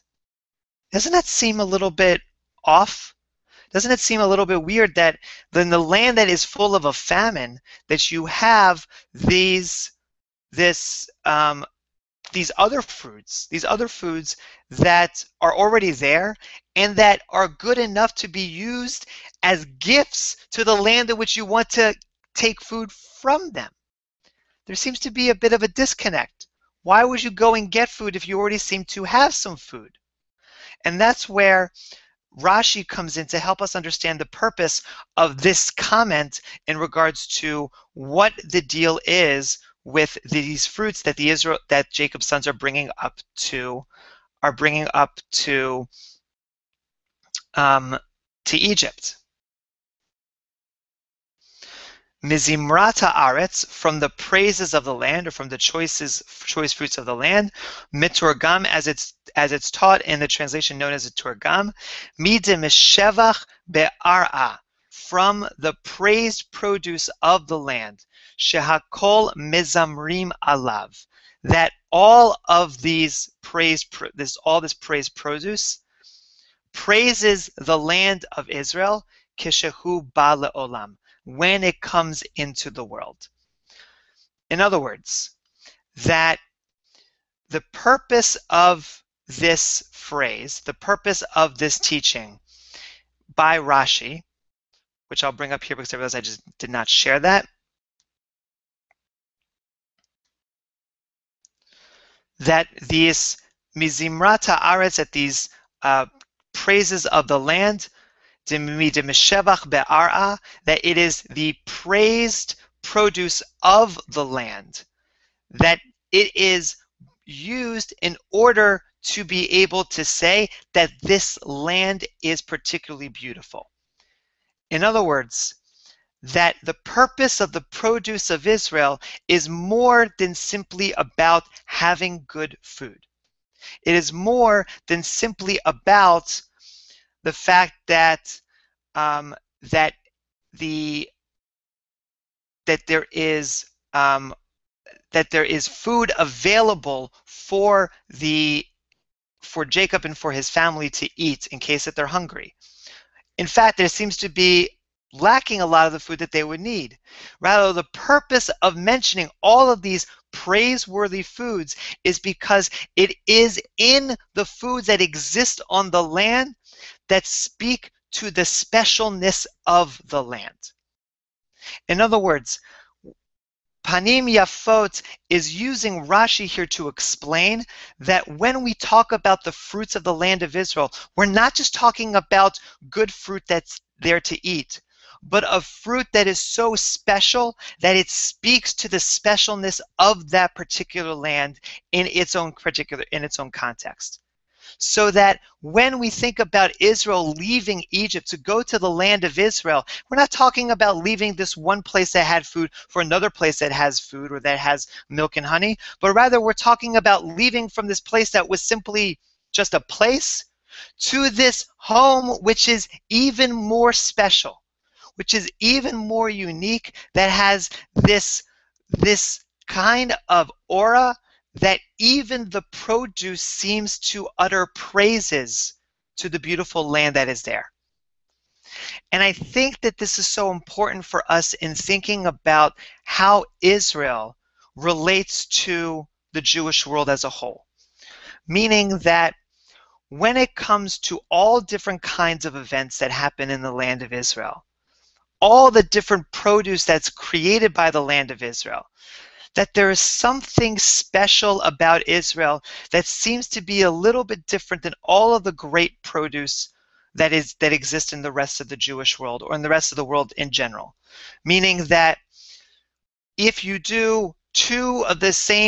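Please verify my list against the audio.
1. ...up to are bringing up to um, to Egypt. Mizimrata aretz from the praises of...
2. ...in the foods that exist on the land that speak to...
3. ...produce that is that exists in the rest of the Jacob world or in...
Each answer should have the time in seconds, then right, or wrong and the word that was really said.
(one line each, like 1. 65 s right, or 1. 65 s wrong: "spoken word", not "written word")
1. 42 s right
2. 163 s right
3. 256 s wrong: "Jewish", not "Jacob".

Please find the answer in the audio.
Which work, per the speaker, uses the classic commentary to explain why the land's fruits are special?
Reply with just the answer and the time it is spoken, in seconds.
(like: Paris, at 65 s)
Panim Yafot, at 173 s.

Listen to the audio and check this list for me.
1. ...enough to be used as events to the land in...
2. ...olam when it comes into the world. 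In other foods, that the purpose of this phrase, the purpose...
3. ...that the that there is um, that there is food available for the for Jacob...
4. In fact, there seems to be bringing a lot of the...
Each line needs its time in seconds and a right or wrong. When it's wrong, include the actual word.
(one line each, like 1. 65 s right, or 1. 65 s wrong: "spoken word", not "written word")
1. 17 s wrong: "gifts", not "events"
2. 80 s wrong: "words", not "foods"
3. 139 s right
4. 153 s wrong: "lacking", not "bringing".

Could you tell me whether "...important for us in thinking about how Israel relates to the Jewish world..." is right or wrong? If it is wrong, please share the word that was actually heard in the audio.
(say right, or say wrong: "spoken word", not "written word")
right.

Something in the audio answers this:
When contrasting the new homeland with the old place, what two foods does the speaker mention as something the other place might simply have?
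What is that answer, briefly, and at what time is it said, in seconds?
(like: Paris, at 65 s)
milk and honey, at 205 s.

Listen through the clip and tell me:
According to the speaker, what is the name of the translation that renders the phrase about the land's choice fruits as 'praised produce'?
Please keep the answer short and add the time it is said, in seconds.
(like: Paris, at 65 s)
Targum, at 61 s.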